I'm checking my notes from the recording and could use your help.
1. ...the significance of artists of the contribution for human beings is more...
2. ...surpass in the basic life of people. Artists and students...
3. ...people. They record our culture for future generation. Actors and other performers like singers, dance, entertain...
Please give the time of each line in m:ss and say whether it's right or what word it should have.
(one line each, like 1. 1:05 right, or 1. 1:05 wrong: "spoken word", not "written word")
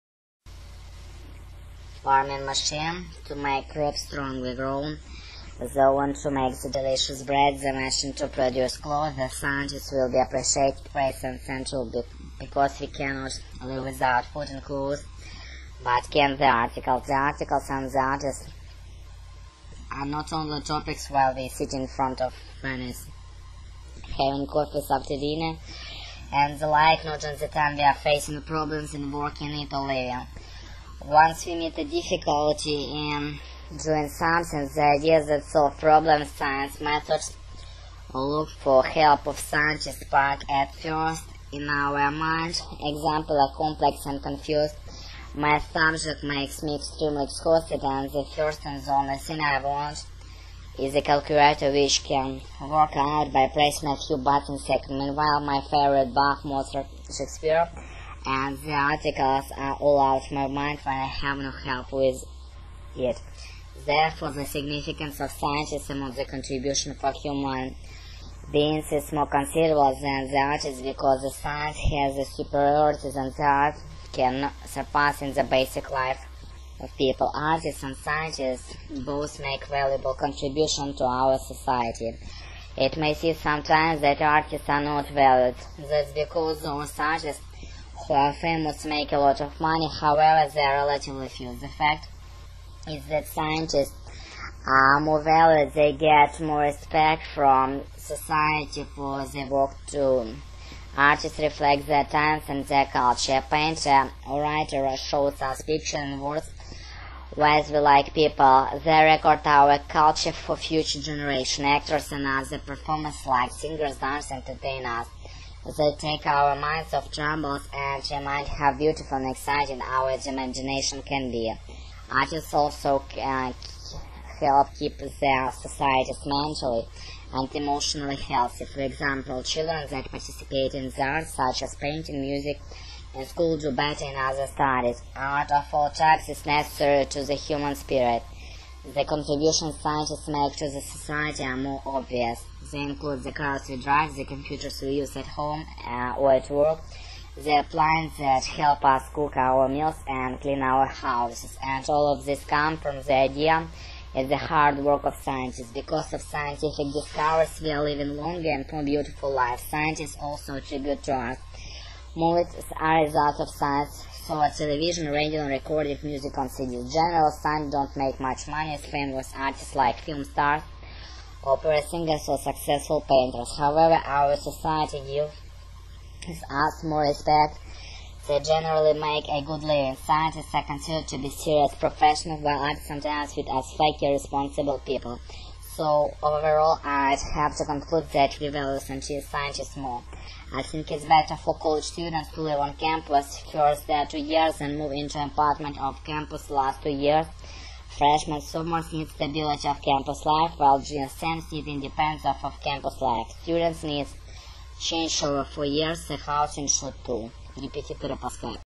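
1. 1:04 wrong: "scientists", not "artists"
2. 1:14 wrong: "scientists", not "students"
3. 1:48 right.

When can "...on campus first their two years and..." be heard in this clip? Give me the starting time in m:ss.
3:12.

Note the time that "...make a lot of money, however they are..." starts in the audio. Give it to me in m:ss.
1:28.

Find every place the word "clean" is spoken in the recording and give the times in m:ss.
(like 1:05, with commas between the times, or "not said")
2:30.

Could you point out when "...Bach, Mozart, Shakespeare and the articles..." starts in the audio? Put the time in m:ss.
0:56.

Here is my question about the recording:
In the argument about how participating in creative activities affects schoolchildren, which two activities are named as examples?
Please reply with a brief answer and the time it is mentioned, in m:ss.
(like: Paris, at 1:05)
painting, music, at 2:11.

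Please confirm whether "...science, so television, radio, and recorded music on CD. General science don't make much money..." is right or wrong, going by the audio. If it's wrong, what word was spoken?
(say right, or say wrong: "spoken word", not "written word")
right.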